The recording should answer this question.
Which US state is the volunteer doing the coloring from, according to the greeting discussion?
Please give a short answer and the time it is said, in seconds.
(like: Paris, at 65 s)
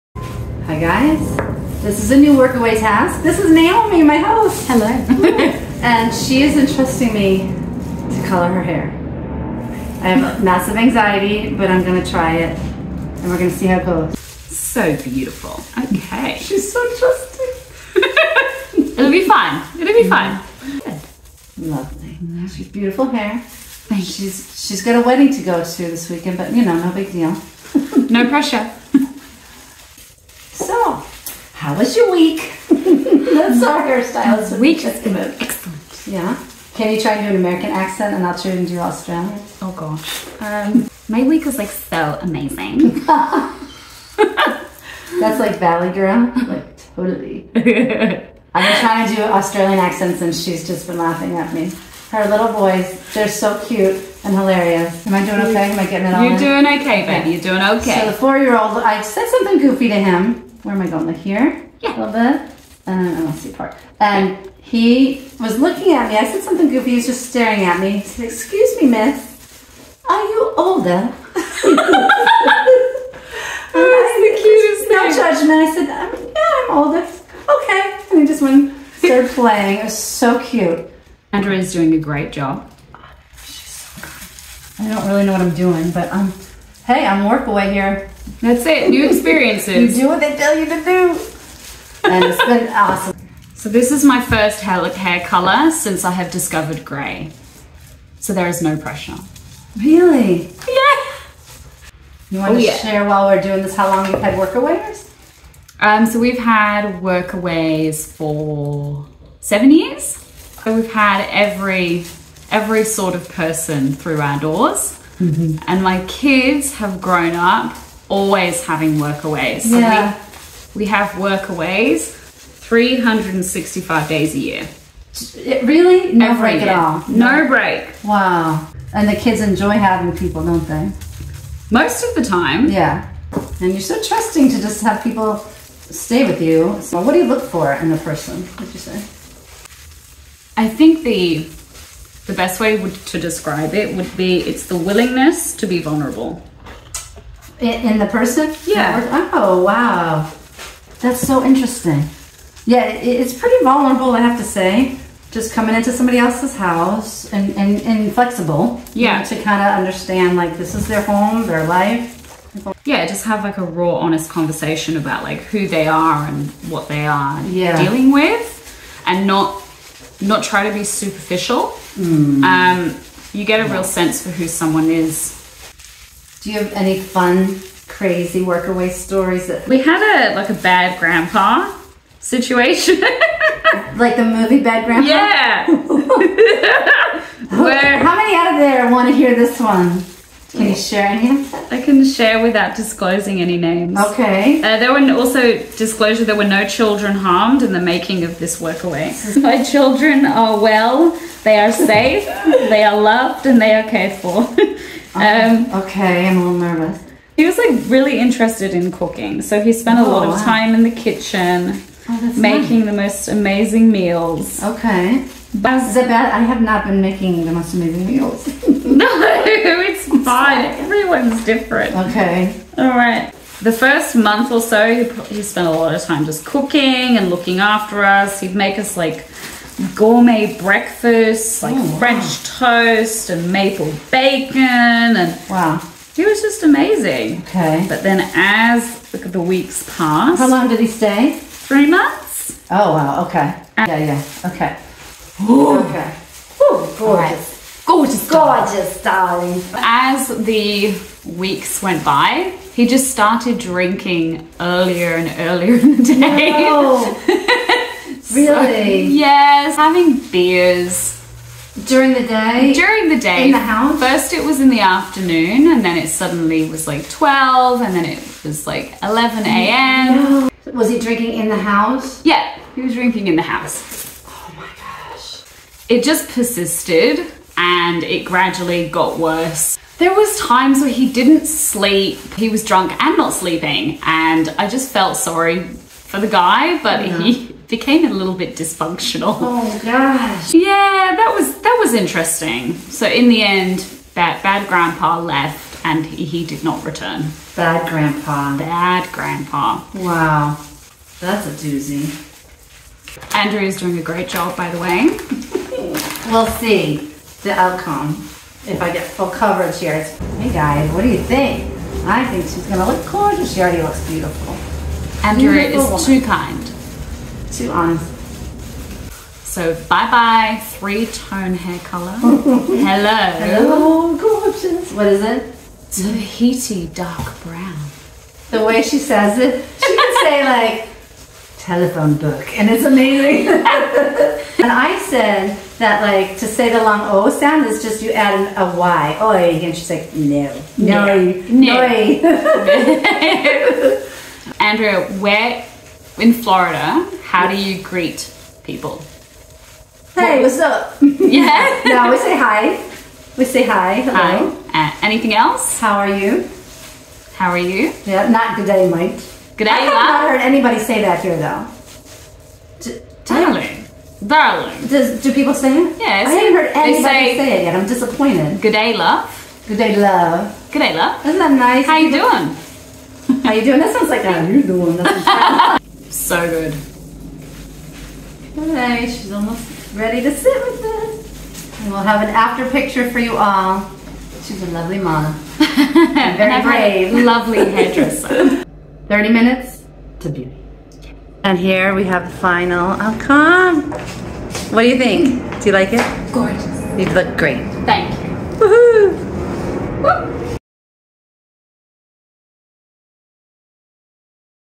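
Florida, at 346 s.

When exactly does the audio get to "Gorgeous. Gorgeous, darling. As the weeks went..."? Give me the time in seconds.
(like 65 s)
247 s.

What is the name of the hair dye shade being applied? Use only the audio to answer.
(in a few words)
Tahiti dark brown.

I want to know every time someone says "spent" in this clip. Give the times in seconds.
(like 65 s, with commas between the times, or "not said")
209 s, 225 s.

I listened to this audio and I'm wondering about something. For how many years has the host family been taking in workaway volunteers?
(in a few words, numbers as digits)
7 years.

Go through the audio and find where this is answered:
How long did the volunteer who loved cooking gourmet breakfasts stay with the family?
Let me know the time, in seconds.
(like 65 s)
241 s.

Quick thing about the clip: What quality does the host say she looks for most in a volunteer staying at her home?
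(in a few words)
Willingness to be vulnerable.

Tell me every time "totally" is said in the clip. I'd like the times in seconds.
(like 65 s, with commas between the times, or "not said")
46 s.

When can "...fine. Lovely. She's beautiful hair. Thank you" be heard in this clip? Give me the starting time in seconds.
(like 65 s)
20 s.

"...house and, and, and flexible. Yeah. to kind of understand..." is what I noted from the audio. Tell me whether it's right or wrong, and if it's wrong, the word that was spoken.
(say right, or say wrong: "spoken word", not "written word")
right.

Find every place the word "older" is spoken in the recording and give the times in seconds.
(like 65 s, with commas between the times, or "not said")
70 s, 76 s.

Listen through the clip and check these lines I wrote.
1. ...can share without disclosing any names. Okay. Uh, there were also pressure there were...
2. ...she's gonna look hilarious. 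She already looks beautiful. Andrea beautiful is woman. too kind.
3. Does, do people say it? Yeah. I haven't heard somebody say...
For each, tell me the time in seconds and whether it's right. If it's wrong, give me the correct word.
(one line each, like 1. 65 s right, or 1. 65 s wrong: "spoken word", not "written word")
1. 191 s wrong: "disclosure", not "pressure"
2. 312 s wrong: "gorgeous", not "hilarious"
3. 364 s wrong: "anybody", not "somebody".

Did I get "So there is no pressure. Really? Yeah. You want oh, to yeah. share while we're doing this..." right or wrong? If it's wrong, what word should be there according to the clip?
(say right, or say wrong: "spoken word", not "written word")
right.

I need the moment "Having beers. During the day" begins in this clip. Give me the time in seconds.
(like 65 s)
259 s.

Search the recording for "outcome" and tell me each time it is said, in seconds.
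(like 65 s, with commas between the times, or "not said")
307 s, 392 s.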